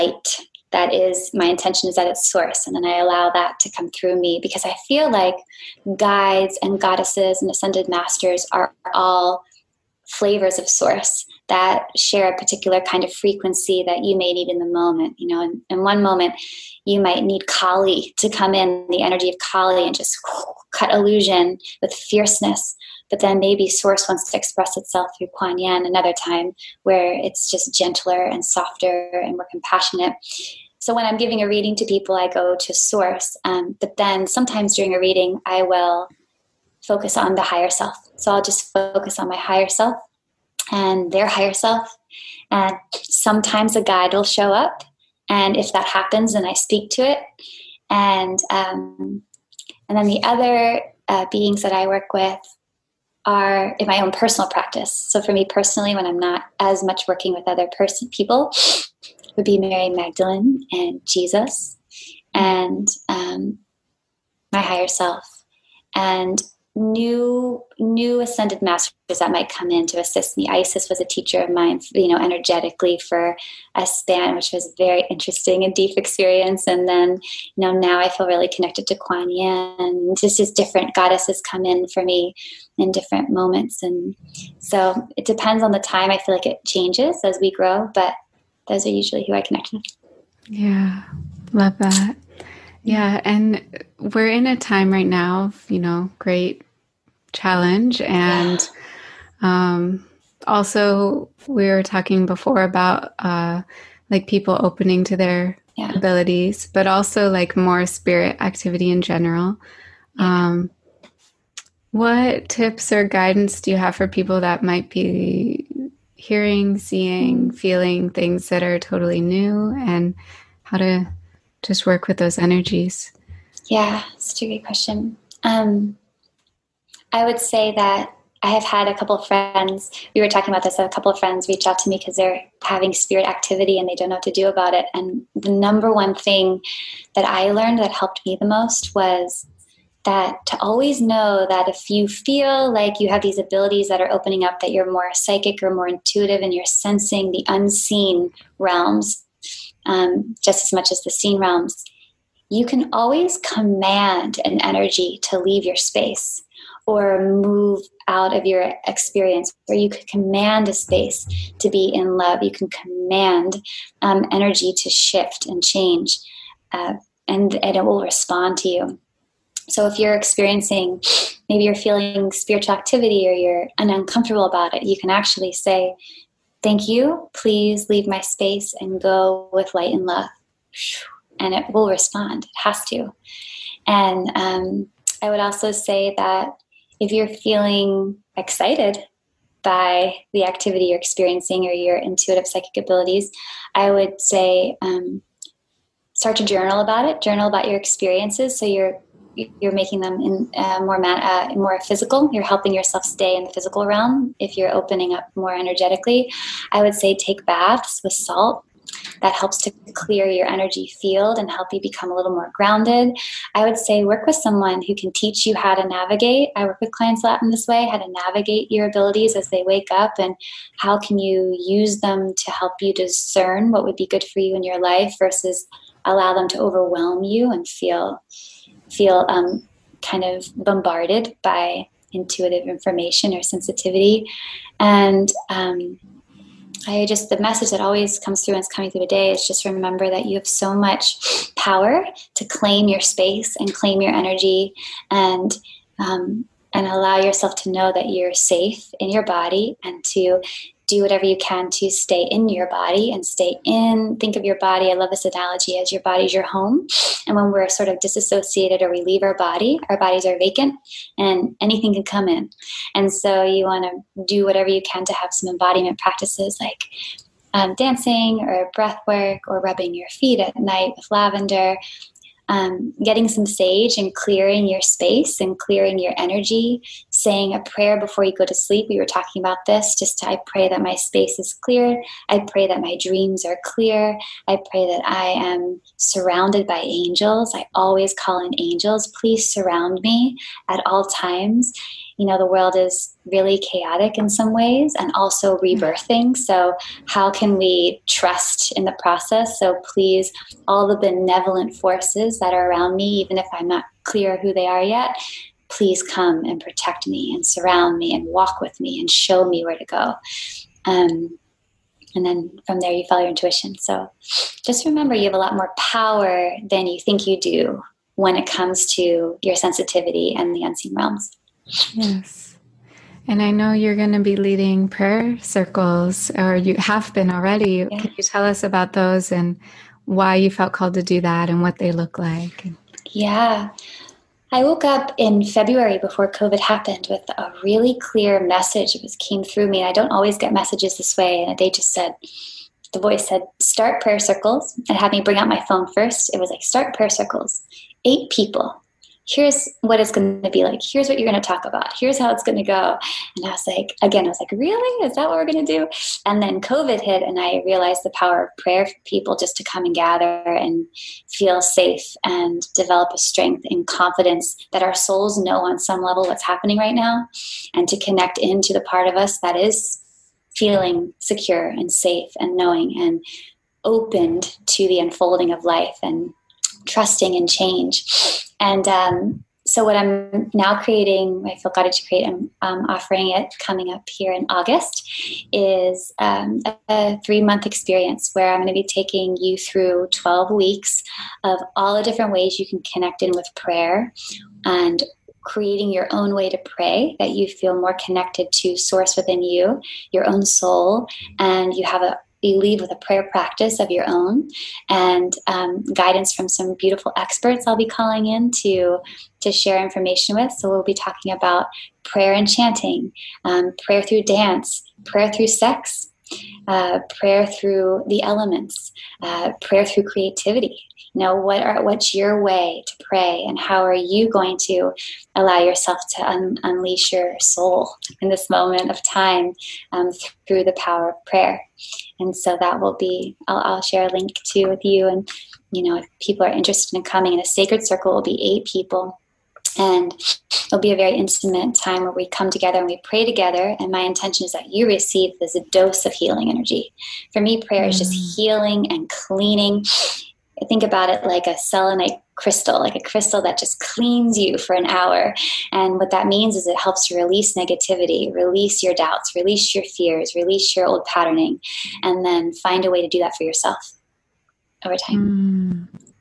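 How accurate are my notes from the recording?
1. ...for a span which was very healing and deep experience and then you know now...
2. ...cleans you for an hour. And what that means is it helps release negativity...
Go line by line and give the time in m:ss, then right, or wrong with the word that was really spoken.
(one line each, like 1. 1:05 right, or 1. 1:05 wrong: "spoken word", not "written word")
1. 1:13 wrong: "interesting", not "healing"
2. 7:33 right.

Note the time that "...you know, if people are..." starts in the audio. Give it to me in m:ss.
7:15.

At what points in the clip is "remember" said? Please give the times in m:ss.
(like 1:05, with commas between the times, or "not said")
3:59, 5:14.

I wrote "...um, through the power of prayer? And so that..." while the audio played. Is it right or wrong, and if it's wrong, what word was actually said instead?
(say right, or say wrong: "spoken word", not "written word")
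right.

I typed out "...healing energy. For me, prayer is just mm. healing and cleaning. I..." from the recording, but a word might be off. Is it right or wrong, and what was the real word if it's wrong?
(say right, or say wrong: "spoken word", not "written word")
right.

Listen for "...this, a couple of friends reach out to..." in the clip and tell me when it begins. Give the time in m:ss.
2:10.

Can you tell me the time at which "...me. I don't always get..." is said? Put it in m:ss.
5:39.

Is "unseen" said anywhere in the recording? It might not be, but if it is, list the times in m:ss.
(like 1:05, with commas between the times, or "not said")
2:27, 5:20.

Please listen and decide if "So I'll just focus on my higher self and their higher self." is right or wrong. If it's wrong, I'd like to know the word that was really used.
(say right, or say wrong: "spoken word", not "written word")
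right.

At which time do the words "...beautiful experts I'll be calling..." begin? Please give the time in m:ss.
6:46.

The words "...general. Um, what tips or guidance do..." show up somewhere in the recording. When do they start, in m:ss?
1:49.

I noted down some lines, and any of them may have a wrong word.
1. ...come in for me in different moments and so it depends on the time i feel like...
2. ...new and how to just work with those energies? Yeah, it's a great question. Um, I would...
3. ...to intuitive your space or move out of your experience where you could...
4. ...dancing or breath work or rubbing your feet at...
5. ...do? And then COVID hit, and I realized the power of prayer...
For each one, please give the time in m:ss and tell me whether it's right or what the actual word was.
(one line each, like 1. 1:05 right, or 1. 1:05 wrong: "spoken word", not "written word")
1. 1:21 right
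2. 1:59 right
3. 2:35 wrong: "leave", not "intuitive"
4. 4:27 right
5. 5:55 right.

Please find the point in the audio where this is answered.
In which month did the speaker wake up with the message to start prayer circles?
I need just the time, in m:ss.
5:35.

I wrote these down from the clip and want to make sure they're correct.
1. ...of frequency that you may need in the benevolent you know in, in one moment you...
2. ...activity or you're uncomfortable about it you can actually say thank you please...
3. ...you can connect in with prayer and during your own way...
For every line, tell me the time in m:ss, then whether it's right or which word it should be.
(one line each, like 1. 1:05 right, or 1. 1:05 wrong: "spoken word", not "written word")
1. 0:13 wrong: "moment", not "benevolent"
2. 2:52 right
3. 6:32 wrong: "creating", not "during".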